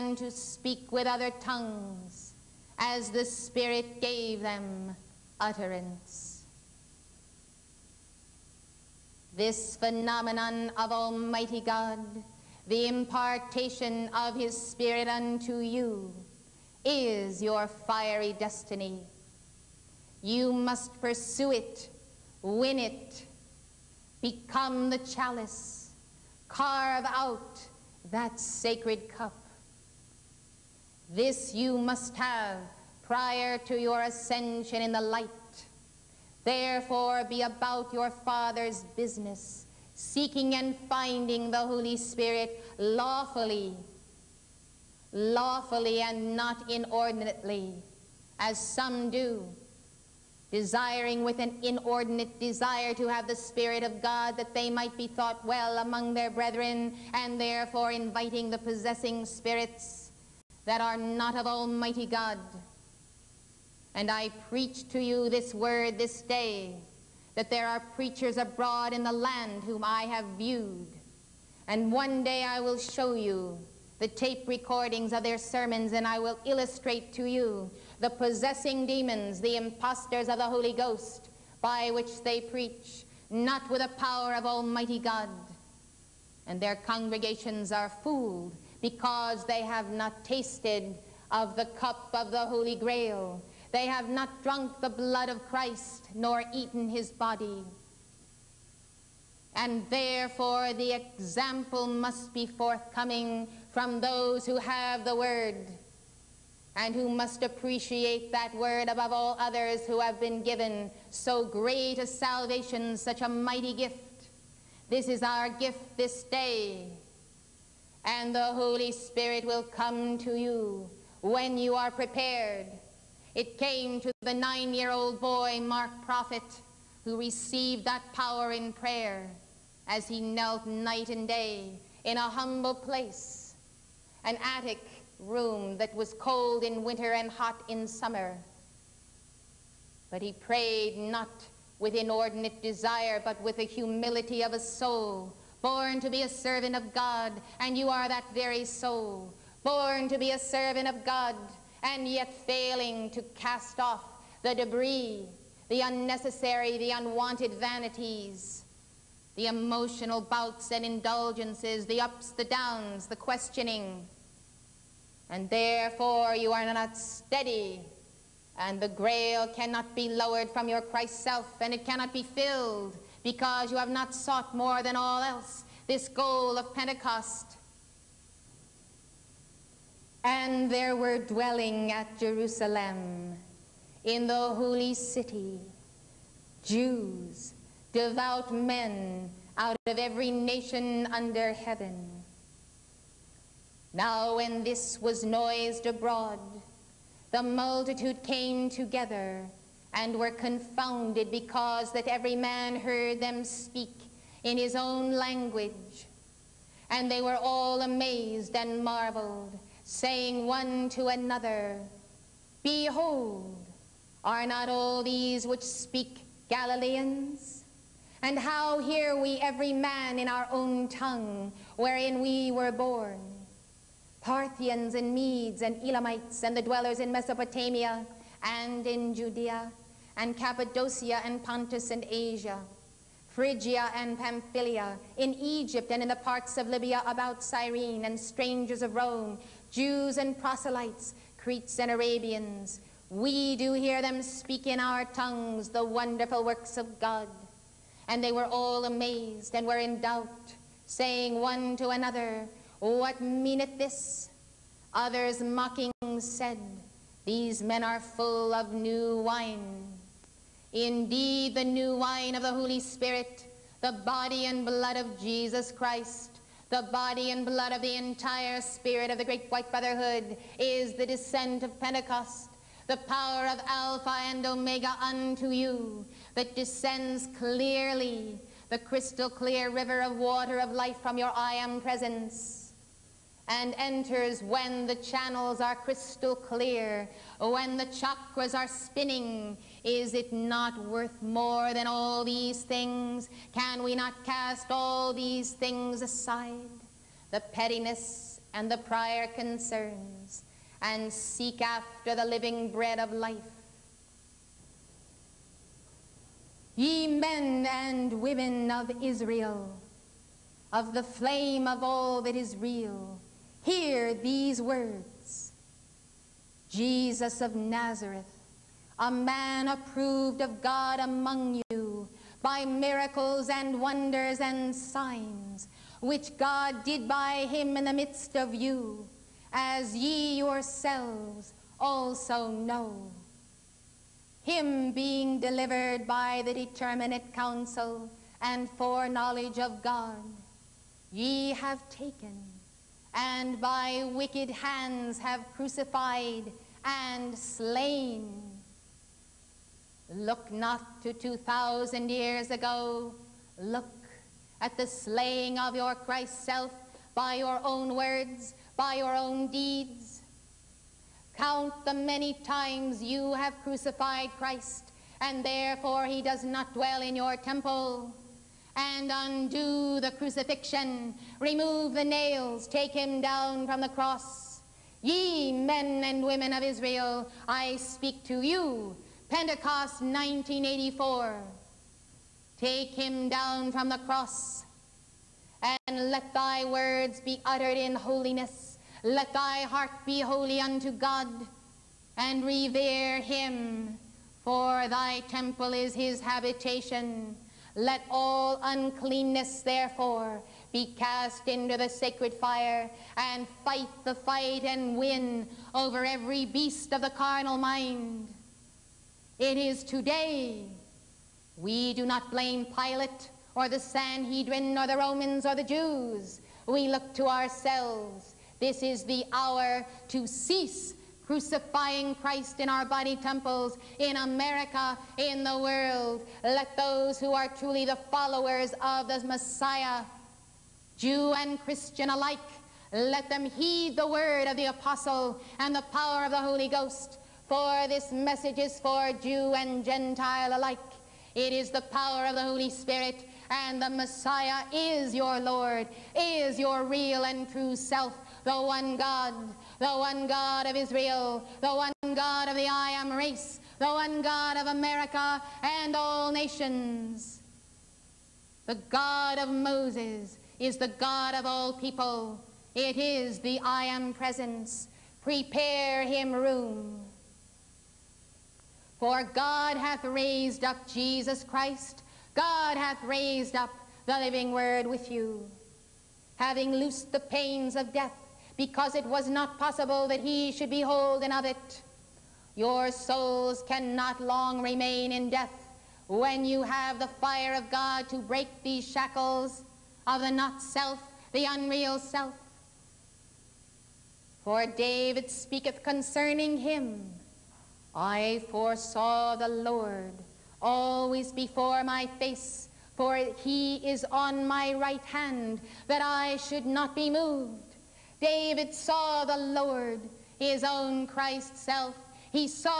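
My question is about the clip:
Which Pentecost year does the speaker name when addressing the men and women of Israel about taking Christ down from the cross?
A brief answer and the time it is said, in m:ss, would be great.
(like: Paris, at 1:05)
1984, at 6:19.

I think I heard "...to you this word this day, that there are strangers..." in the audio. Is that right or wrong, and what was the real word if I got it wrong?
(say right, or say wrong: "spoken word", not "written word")
wrong: "preachers", not "strangers".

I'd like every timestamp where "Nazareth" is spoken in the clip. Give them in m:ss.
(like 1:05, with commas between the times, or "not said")
5:17.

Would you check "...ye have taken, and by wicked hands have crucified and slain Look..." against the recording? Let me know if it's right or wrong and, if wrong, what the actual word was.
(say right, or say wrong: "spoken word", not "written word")
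right.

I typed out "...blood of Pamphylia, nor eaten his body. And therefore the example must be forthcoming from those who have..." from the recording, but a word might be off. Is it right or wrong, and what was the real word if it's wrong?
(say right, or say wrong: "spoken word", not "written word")
wrong: "Christ", not "Pamphylia".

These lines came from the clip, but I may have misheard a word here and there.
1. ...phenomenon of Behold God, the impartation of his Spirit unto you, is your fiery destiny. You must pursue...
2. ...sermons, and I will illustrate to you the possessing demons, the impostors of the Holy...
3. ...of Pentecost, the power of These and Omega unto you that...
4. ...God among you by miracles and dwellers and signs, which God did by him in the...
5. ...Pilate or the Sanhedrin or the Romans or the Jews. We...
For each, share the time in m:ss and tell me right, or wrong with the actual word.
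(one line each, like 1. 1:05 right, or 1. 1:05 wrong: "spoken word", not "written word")
1. 0:09 wrong: "Almighty", not "Behold"
2. 1:15 right
3. 4:31 wrong: "Alpha", not "These"
4. 5:20 wrong: "wonders", not "dwellers"
5. 6:52 right.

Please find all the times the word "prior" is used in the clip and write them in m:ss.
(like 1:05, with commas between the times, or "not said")
0:33, 4:58.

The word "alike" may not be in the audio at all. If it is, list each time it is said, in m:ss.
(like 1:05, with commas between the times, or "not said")
7:12, 7:20.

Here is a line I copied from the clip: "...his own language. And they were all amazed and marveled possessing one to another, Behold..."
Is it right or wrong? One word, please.
wrong.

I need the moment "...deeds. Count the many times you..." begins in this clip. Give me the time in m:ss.
5:59.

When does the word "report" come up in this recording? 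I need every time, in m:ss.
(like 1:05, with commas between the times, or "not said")
not said.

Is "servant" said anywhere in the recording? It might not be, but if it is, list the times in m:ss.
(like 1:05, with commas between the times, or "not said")
2:26, 2:30.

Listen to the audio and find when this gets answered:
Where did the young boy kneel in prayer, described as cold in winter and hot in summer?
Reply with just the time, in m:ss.
2:14.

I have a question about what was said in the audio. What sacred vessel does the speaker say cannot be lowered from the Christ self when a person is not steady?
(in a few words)
the grail.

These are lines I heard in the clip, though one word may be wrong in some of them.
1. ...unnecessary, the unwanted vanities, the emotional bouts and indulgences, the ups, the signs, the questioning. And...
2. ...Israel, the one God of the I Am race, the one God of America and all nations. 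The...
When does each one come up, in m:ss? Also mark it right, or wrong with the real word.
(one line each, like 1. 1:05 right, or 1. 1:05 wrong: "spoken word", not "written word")
1. 2:35 wrong: "downs", not "signs"
2. 7:30 right.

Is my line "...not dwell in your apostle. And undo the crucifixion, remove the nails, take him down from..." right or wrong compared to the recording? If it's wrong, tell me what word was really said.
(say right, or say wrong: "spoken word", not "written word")
wrong: "temple", not "apostle".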